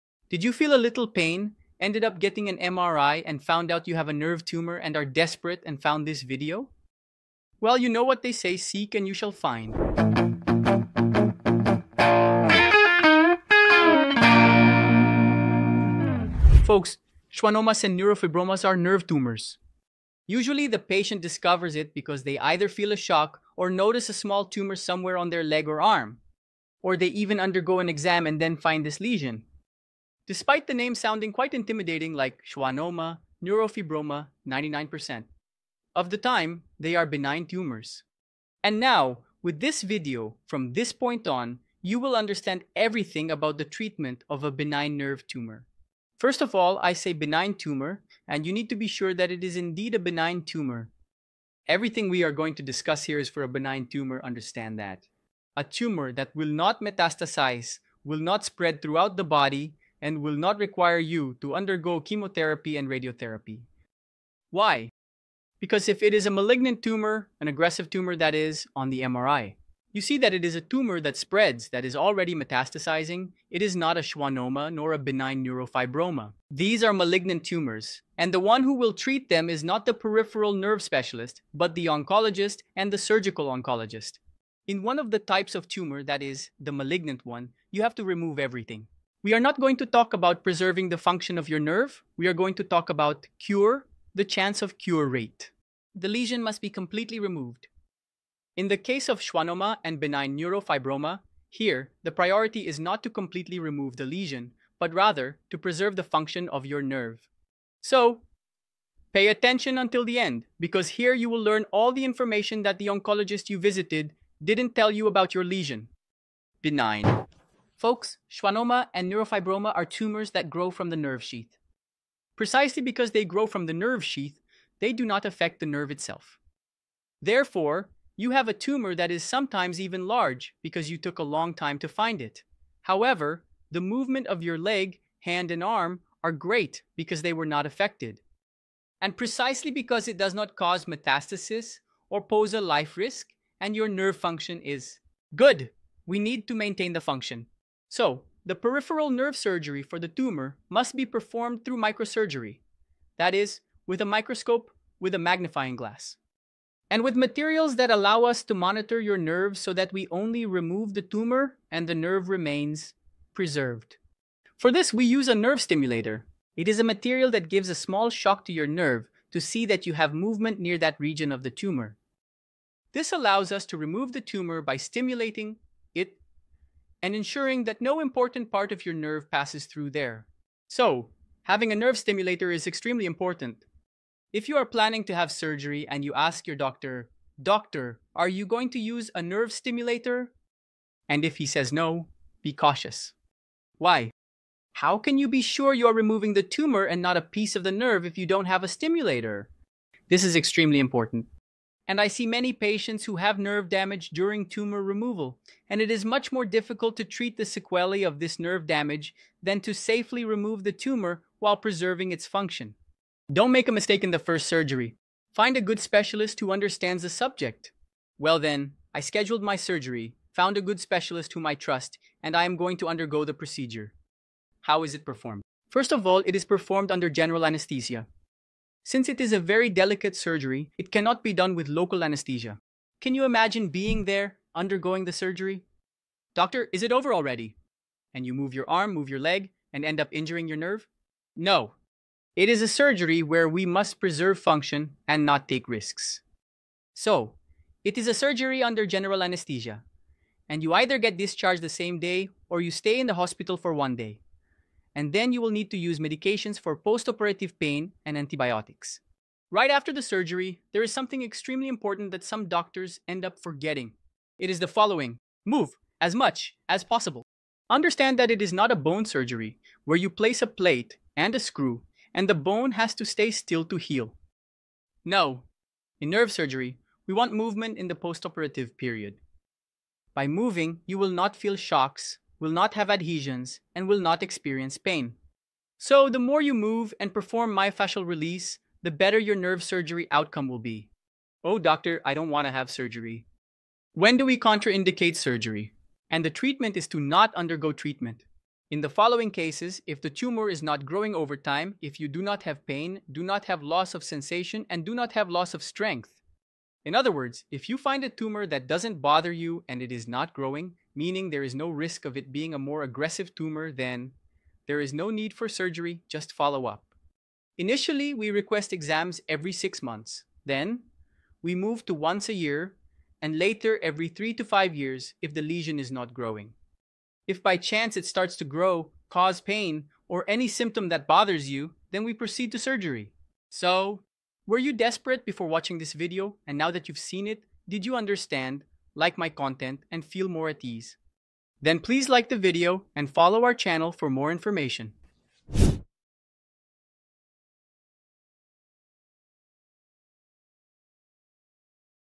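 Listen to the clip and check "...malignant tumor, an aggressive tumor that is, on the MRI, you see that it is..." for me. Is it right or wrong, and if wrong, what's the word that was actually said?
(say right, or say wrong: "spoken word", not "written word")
right.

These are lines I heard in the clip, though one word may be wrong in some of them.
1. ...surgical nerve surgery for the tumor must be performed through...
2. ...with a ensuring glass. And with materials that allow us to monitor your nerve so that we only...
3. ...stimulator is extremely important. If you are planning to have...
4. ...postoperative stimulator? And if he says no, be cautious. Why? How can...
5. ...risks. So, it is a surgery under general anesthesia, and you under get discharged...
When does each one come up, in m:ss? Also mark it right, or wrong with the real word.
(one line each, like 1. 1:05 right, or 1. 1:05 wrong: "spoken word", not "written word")
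1. 2:28 wrong: "peripheral", not "surgical"
2. 2:35 wrong: "magnifying", not "ensuring"
3. 3:01 right
4. 3:09 wrong: "nerve", not "postoperative"
5. 4:05 wrong: "either", not "under".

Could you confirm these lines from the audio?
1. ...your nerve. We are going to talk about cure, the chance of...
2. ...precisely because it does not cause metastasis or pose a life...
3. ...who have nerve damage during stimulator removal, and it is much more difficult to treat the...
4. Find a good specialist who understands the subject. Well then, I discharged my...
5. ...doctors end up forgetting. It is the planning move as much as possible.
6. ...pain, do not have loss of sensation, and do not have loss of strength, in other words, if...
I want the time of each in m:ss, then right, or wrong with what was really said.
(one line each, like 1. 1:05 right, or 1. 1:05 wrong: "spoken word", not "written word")
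1. 1:31 right
2. 2:19 right
3. 3:23 wrong: "tumor", not "stimulator"
4. 3:35 wrong: "scheduled", not "discharged"
5. 4:22 wrong: "following", not "planning"
6. 5:02 right.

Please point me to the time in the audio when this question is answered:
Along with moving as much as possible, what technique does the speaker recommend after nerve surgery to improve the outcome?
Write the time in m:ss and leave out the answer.
4:47.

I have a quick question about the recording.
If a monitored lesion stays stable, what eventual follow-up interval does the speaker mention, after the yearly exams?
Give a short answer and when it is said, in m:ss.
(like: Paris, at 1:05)
Every 3 to 5 years, at 5:23.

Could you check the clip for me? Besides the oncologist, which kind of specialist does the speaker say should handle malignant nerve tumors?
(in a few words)
Surgical oncologist.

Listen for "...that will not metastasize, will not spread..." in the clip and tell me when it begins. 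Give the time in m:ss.
0:56.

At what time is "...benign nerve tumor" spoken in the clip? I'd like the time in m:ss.
0:44.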